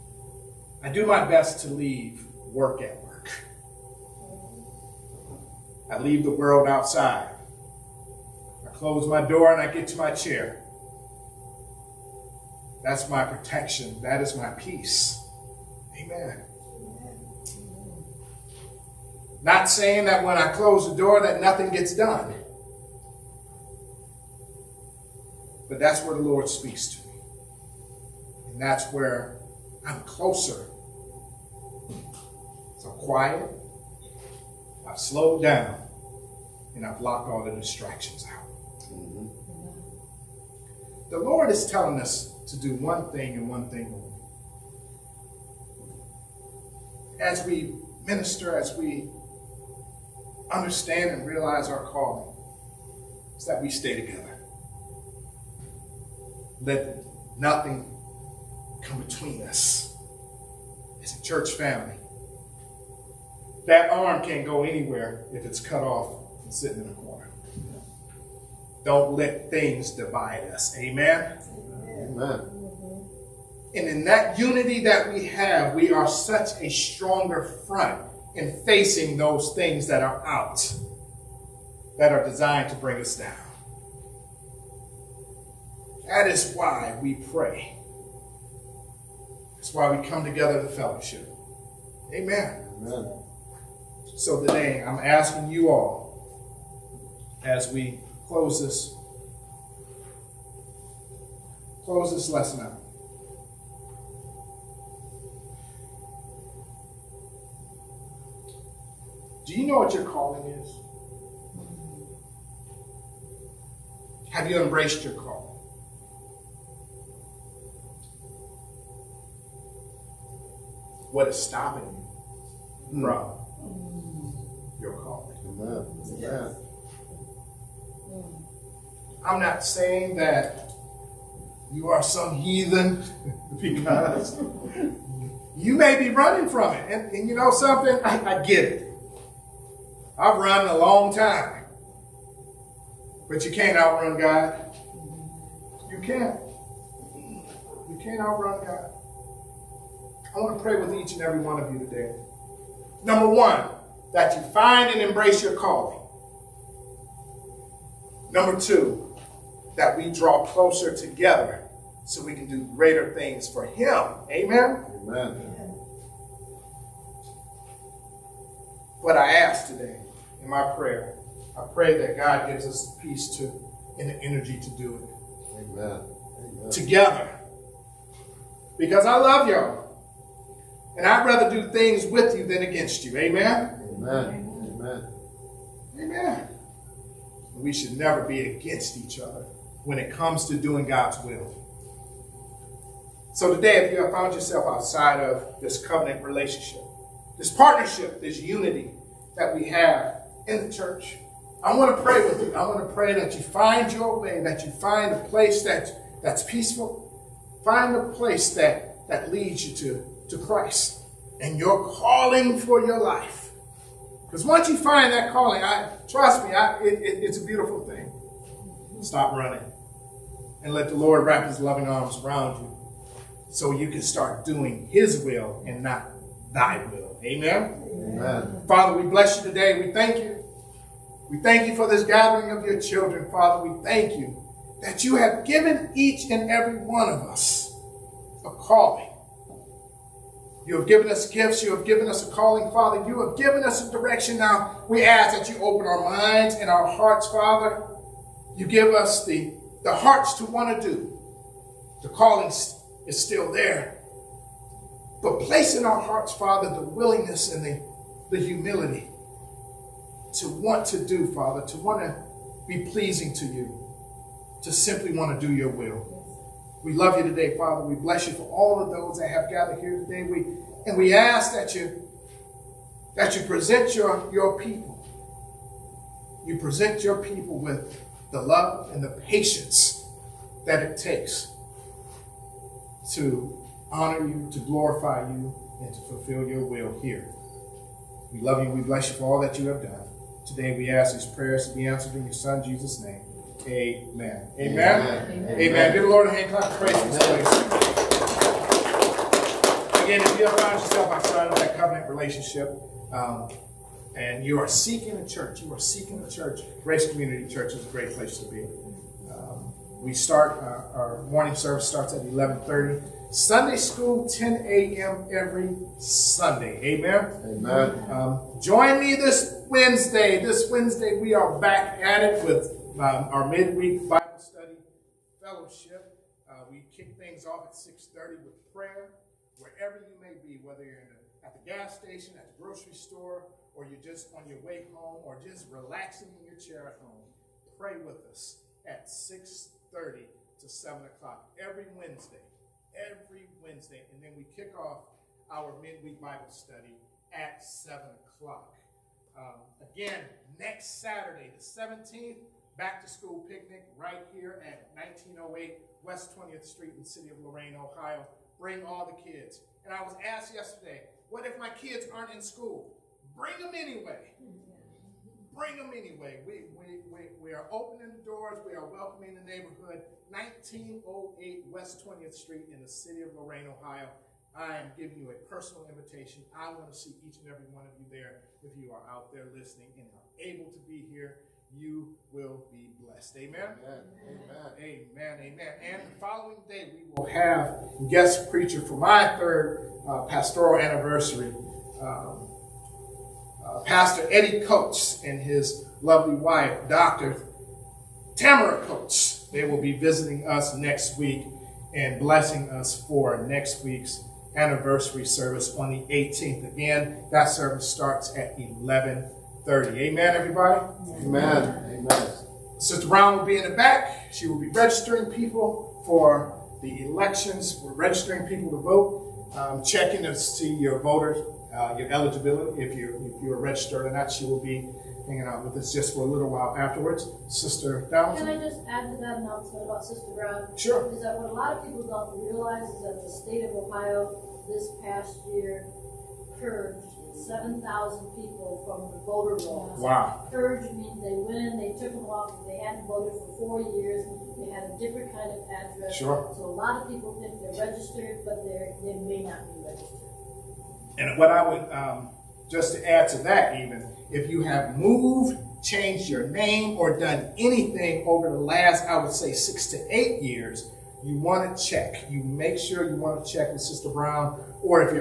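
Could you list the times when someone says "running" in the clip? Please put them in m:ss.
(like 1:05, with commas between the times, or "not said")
2:16, 3:39.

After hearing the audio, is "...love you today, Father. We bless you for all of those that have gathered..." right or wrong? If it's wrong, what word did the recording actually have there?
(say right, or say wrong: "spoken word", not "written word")
right.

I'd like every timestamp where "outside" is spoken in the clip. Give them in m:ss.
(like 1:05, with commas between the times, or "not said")
0:06, 3:14, 5:01.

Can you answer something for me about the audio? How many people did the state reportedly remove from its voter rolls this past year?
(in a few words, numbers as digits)
7,000.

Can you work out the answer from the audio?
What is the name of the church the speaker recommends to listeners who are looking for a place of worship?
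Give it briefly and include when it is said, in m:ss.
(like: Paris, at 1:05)
Grace Community Church, at 5:06.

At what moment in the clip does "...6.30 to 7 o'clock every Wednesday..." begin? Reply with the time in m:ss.
5:39.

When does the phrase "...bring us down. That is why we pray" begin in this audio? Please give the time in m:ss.
1:22.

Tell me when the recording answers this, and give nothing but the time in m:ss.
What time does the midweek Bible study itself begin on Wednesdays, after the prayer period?
5:45.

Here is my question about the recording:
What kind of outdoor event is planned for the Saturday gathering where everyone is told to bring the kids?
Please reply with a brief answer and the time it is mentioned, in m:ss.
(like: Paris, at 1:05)
Back to school picnic, at 5:52.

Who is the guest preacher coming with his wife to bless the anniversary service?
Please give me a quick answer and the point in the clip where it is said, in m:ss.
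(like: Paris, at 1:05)
Pastor Eddie Coates, at 6:33.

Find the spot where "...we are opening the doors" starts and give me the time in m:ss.
6:07.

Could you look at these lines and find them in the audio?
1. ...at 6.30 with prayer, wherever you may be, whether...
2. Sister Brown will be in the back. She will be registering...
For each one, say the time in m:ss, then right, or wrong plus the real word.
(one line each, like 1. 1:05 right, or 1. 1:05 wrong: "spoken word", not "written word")
1. 5:27 right
2. 6:52 right.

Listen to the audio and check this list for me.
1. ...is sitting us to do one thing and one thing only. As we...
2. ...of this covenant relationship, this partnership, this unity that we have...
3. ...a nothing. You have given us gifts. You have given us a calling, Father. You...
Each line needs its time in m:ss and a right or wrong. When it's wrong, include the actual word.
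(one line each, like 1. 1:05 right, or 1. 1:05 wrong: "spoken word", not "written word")
1. 0:41 wrong: "telling", not "sitting"
2. 3:15 right
3. 3:58 wrong: "calling", not "nothing".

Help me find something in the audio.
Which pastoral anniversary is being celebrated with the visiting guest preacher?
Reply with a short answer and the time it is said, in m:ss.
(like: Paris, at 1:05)
Third, at 6:29.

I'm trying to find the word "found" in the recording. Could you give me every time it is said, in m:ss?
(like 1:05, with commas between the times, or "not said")
3:14, 5:00.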